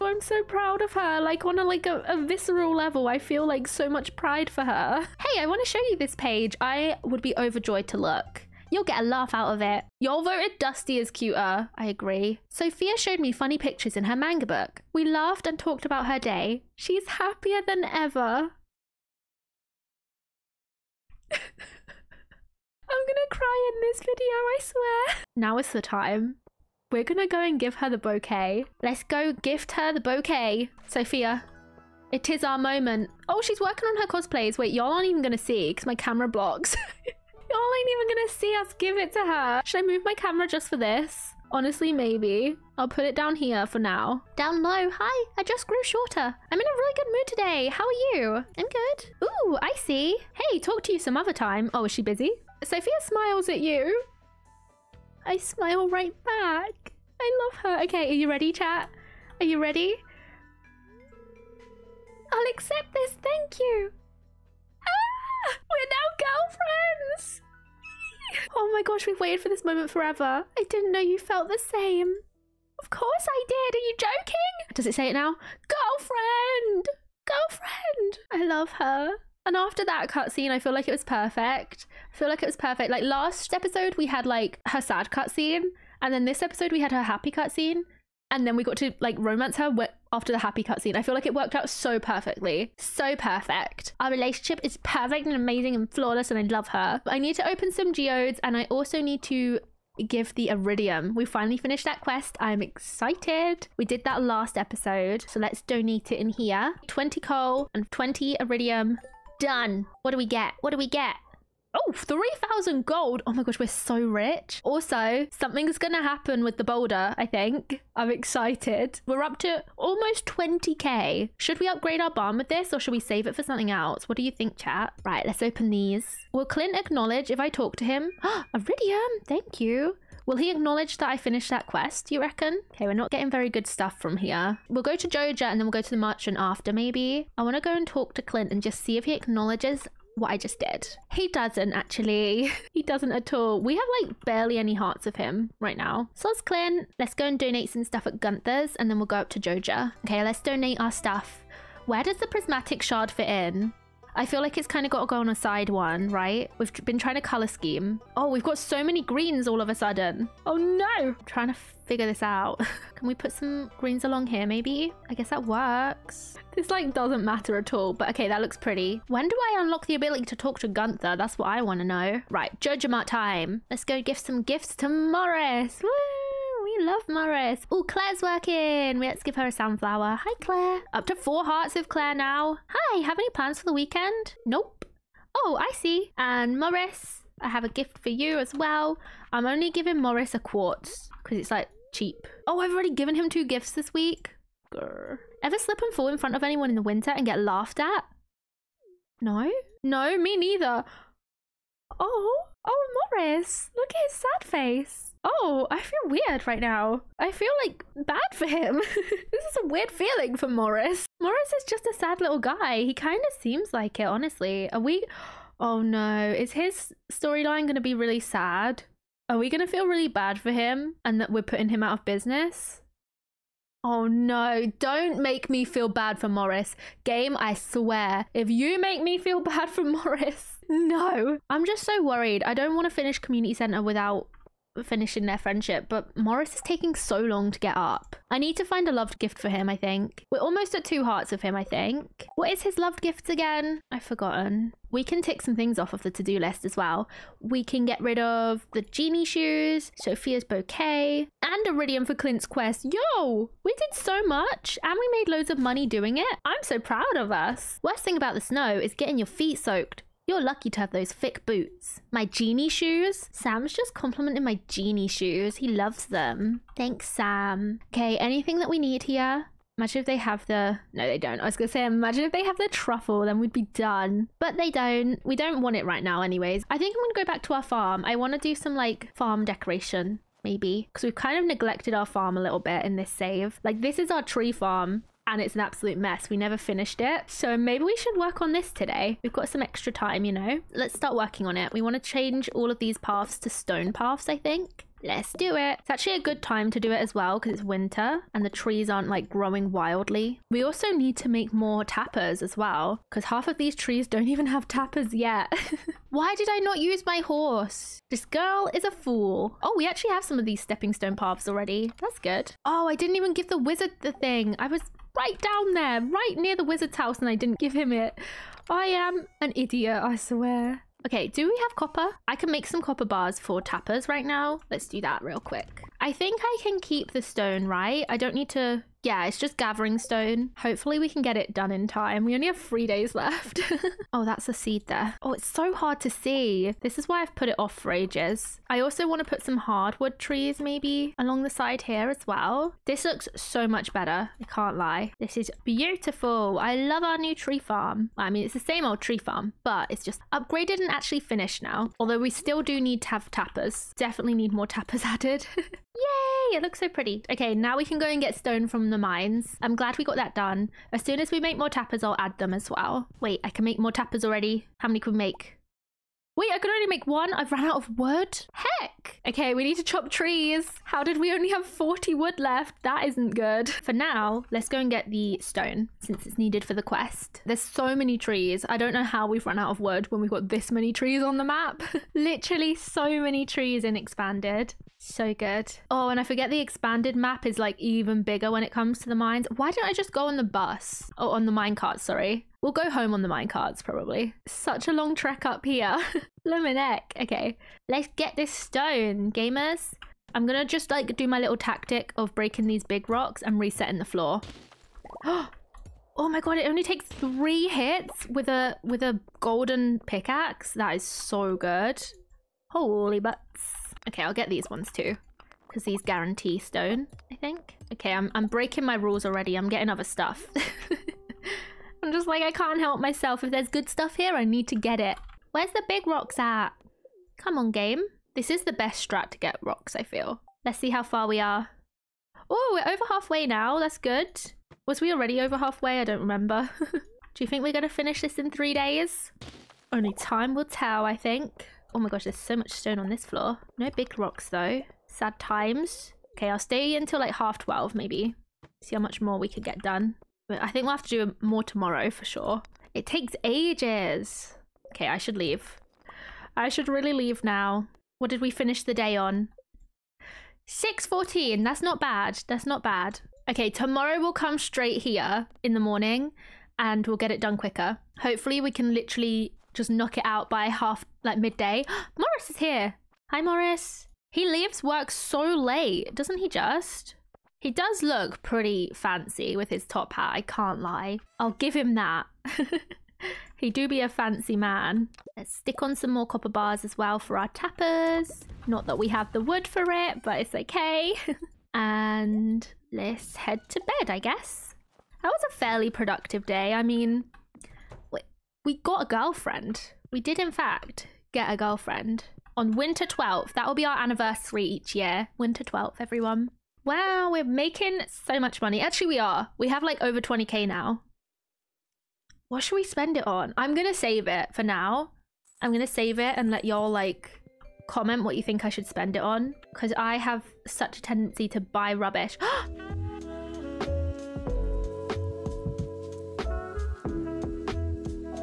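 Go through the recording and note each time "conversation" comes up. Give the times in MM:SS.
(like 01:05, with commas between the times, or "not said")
not said.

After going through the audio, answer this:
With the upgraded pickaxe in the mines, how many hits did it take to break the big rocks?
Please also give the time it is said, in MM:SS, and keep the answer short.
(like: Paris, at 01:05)
3, at 06:47.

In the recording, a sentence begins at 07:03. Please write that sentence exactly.
If there's good stuff here, I need to get it.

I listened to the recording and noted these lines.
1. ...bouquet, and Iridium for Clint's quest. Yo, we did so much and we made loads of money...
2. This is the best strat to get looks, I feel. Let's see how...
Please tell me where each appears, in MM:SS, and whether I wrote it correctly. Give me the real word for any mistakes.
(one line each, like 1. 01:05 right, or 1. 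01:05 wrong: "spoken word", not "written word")
1. 04:10 right
2. 07:08 wrong: "rocks", not "looks".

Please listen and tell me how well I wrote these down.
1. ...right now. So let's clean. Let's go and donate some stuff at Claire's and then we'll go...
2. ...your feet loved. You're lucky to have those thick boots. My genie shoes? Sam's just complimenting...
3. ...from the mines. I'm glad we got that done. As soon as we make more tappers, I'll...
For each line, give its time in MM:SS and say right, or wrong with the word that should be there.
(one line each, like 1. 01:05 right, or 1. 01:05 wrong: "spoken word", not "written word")
1. 02:25 wrong: "Gunther", not "Claire"
2. 04:19 wrong: "soaked", not "loved"
3. 05:58 right.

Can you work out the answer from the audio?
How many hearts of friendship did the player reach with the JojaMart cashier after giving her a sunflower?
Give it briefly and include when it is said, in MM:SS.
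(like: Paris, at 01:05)
four hearts, at 03:01.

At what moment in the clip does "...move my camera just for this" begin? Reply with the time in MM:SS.
00:39.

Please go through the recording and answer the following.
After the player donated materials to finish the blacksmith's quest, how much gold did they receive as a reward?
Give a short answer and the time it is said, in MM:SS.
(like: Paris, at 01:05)
3,000 gold, at 01:51.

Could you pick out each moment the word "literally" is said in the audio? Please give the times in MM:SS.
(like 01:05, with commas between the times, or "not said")
06:22, 07:48.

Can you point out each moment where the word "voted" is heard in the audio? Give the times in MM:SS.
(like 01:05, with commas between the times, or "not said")
00:10.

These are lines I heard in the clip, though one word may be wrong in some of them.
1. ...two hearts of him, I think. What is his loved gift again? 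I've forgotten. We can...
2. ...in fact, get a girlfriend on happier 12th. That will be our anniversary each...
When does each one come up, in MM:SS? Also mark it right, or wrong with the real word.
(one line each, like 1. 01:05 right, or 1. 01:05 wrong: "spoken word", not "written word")
1. 04:00 right
2. 08:20 wrong: "winter", not "happier".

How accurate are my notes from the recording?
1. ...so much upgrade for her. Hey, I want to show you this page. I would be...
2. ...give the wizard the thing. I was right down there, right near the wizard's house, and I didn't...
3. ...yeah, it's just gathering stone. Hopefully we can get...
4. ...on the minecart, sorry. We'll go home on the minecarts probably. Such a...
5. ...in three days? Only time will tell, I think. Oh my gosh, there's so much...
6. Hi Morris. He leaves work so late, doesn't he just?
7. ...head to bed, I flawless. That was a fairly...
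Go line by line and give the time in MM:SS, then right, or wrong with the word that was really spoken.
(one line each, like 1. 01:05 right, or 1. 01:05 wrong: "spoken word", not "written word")
1. 00:03 wrong: "pride", not "upgrade"
2. 05:13 right
3. 05:29 right
4. 06:31 right
5. 07:18 right
6. 07:53 right
7. 08:13 wrong: "guess", not "flawless".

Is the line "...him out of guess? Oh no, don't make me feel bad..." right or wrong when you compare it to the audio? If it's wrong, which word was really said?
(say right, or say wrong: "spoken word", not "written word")
wrong: "business", not "guess".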